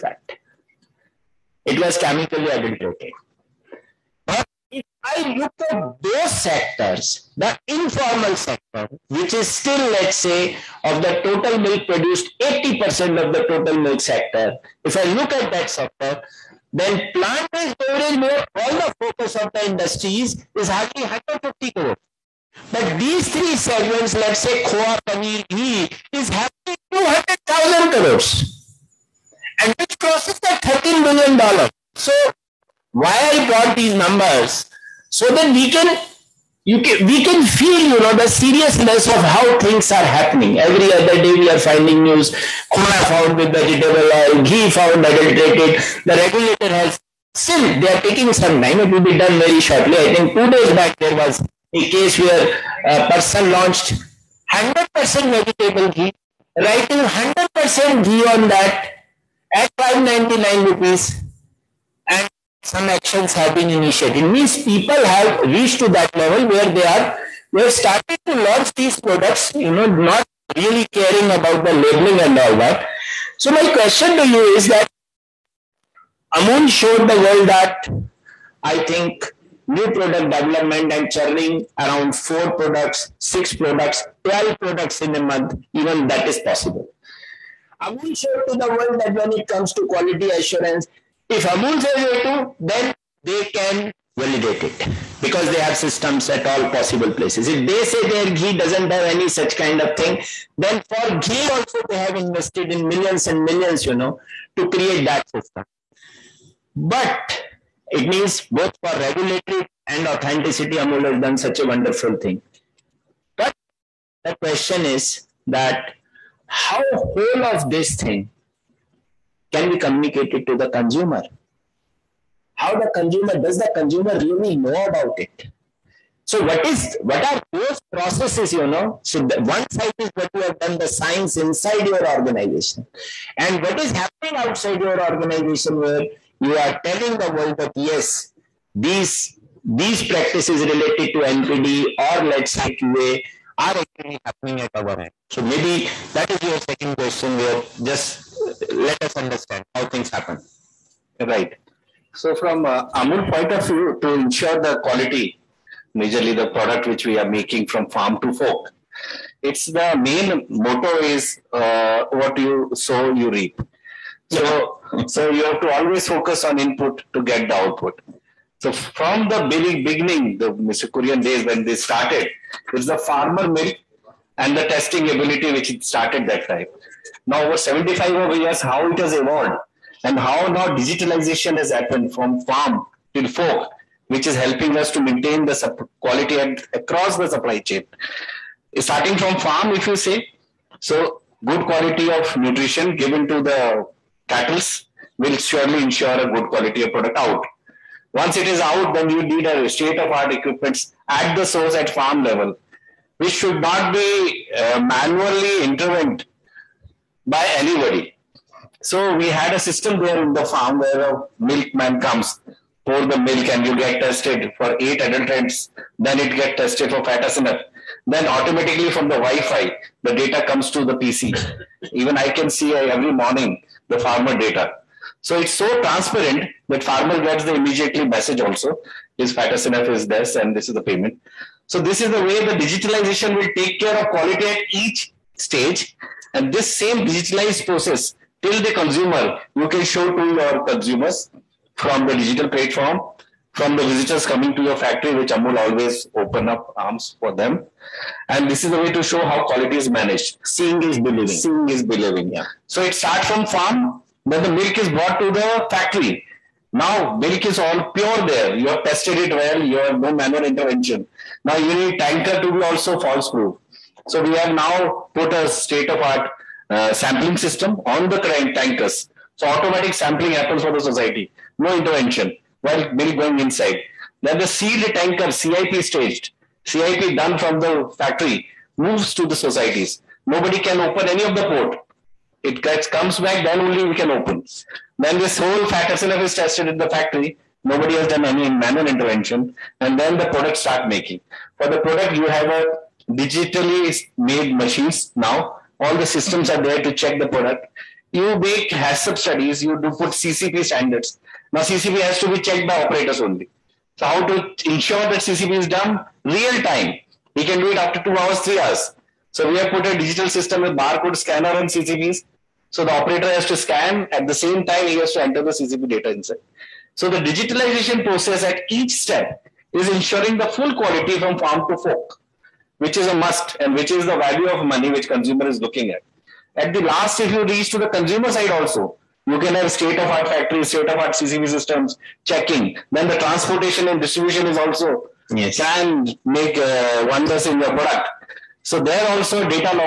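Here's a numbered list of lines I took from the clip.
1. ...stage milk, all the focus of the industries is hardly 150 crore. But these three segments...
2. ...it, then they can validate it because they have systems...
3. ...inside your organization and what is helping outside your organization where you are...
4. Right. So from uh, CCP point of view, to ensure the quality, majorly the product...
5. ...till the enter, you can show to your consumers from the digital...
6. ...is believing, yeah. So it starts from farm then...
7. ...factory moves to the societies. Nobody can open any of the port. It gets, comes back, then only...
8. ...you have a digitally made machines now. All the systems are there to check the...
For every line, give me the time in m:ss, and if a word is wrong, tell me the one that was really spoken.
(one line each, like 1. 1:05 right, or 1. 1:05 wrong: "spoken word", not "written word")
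1. 0:17 wrong: "beverage", not "stage"
2. 1:32 right
3. 2:11 wrong: "happening", not "helping"
4. 2:31 wrong: "Amul", not "CCP"
5. 3:58 wrong: "consumer", not "enter"
6. 4:11 right
7. 4:37 right
8. 4:52 right.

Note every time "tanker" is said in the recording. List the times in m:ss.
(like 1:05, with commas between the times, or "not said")
4:21, 4:28, 4:34.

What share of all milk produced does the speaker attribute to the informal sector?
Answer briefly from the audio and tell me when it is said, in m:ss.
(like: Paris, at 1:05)
80%, at 0:12.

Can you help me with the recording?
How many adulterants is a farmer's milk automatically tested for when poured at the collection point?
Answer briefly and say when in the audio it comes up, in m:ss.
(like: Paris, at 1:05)
8, at 3:34.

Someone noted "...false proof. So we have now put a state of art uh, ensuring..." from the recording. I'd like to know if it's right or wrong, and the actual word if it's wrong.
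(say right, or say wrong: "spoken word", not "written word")
wrong: "sampling", not "ensuring".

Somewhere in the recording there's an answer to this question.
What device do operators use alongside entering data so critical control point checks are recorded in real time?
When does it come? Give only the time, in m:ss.
5:10.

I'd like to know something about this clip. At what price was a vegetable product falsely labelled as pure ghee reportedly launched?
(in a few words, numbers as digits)
599 rupees.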